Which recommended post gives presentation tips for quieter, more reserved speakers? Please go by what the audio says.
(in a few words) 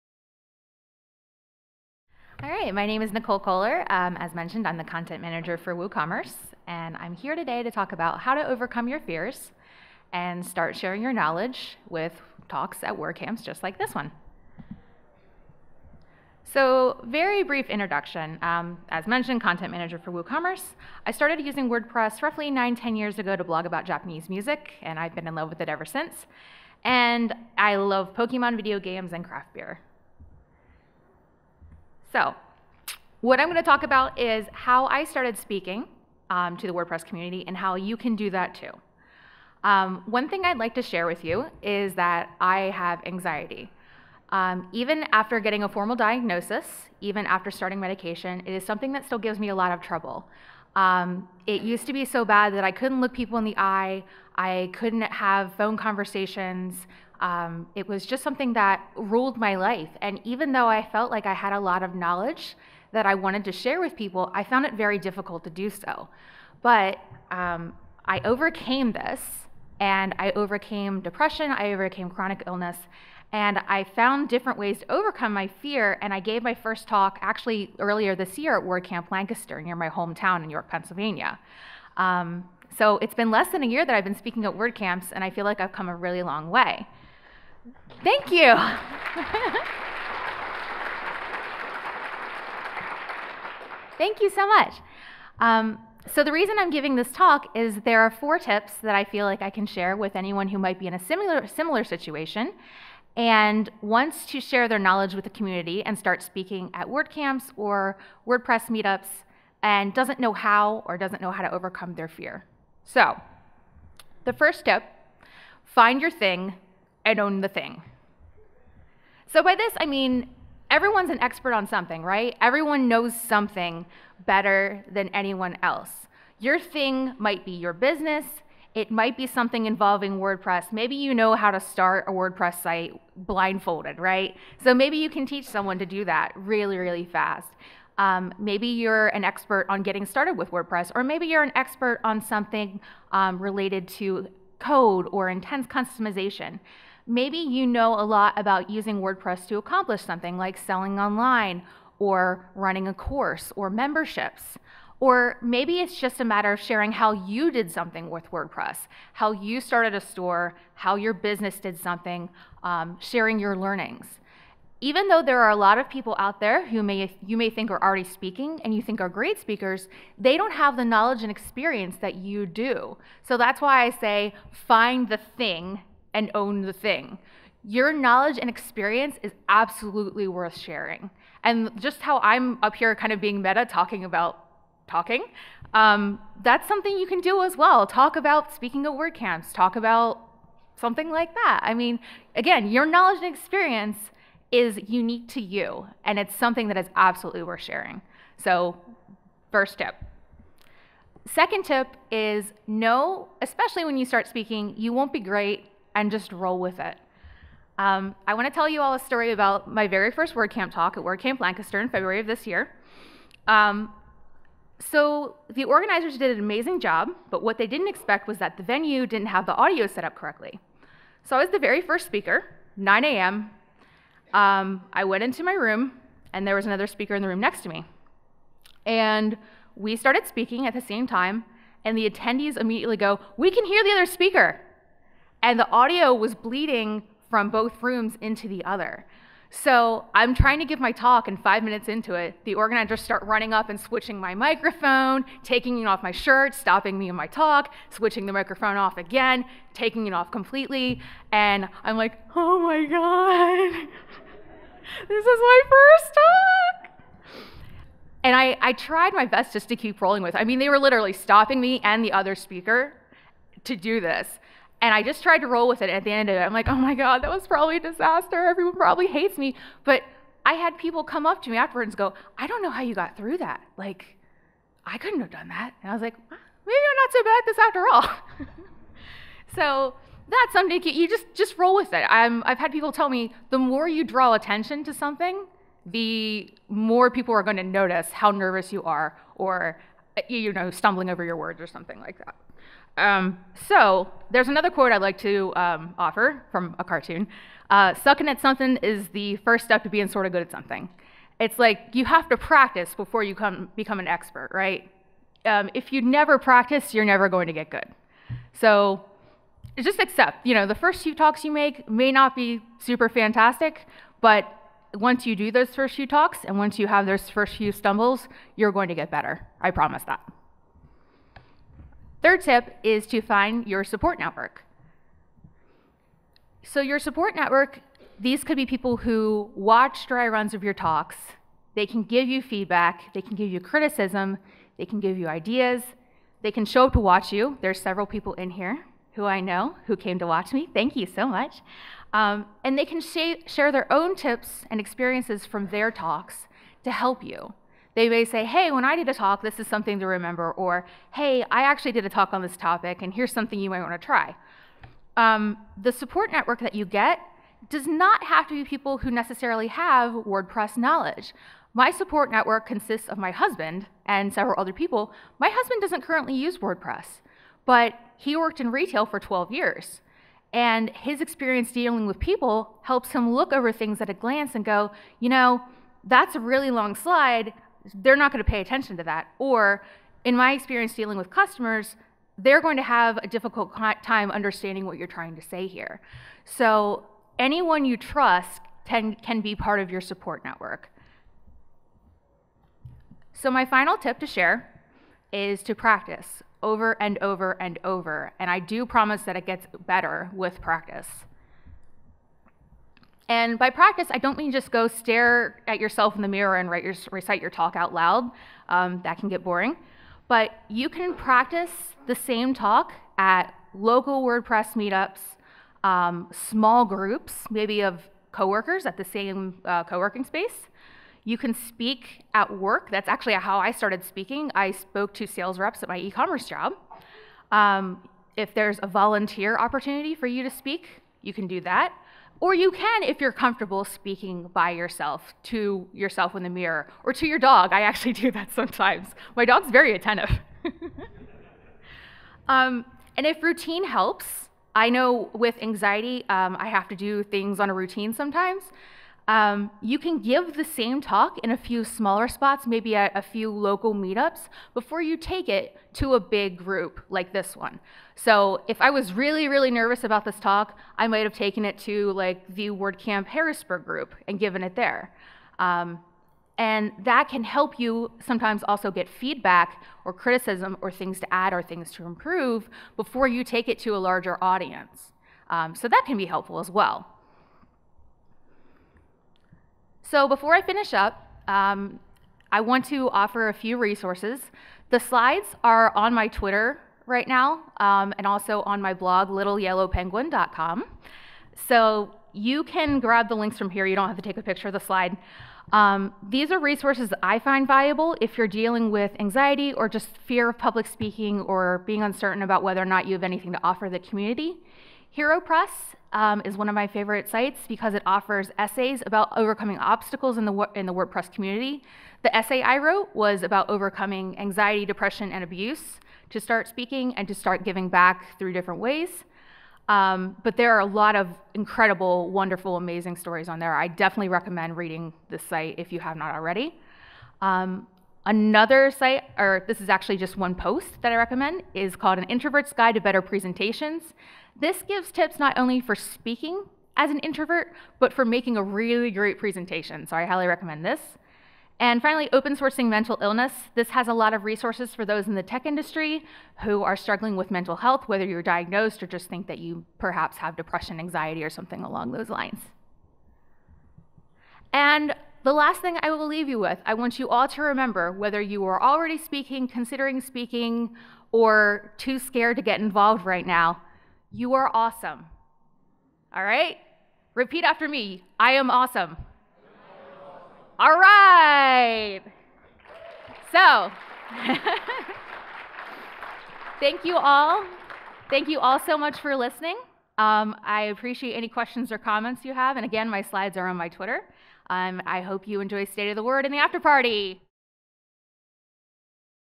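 An Introvert's Guide to Better Presentations.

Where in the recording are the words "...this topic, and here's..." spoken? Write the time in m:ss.
5:52.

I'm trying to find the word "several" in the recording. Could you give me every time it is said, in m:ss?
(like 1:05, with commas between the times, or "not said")
5:37, 6:04.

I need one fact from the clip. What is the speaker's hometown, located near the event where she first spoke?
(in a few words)
York, Pennsylvania.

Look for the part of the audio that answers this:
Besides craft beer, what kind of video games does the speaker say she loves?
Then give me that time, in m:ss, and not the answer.
0:28.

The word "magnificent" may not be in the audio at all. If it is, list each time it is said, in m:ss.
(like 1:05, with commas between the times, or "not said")
not said.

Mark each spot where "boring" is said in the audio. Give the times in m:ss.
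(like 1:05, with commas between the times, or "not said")
6:49.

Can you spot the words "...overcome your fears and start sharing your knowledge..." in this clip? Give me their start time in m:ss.
0:08.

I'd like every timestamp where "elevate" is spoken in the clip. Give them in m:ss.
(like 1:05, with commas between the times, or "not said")
not said.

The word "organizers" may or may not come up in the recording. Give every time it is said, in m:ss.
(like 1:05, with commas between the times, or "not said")
3:35, 4:02.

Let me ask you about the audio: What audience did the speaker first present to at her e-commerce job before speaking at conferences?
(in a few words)
sales reps.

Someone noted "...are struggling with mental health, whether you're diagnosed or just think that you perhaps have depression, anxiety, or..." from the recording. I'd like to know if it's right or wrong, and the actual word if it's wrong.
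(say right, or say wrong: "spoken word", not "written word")
right.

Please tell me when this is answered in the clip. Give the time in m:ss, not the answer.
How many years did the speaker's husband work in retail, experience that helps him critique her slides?
6:09.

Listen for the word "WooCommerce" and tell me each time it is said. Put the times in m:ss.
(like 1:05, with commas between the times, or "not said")
0:05, 0:20.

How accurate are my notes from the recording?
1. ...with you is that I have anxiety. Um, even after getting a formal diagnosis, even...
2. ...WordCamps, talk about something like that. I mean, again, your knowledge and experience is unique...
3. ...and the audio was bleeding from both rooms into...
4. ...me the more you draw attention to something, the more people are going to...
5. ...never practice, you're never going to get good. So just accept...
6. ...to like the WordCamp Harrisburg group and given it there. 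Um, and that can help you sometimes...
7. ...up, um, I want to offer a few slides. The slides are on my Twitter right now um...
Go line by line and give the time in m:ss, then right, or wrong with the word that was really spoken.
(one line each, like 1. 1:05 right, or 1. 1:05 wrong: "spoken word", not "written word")
1. 0:41 right
2. 3:08 right
3. 3:55 right
4. 4:43 right
5. 5:06 right
6. 7:41 right
7. 8:00 wrong: "resources", not "slides".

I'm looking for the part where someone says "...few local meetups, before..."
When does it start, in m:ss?
7:33.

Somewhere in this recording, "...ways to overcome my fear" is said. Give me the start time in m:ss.
1:14.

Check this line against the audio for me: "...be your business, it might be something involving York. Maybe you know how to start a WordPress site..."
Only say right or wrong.
wrong.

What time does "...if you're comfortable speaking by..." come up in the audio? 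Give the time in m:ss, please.
7:13.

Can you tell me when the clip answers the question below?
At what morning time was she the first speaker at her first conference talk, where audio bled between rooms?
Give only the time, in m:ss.
3:42.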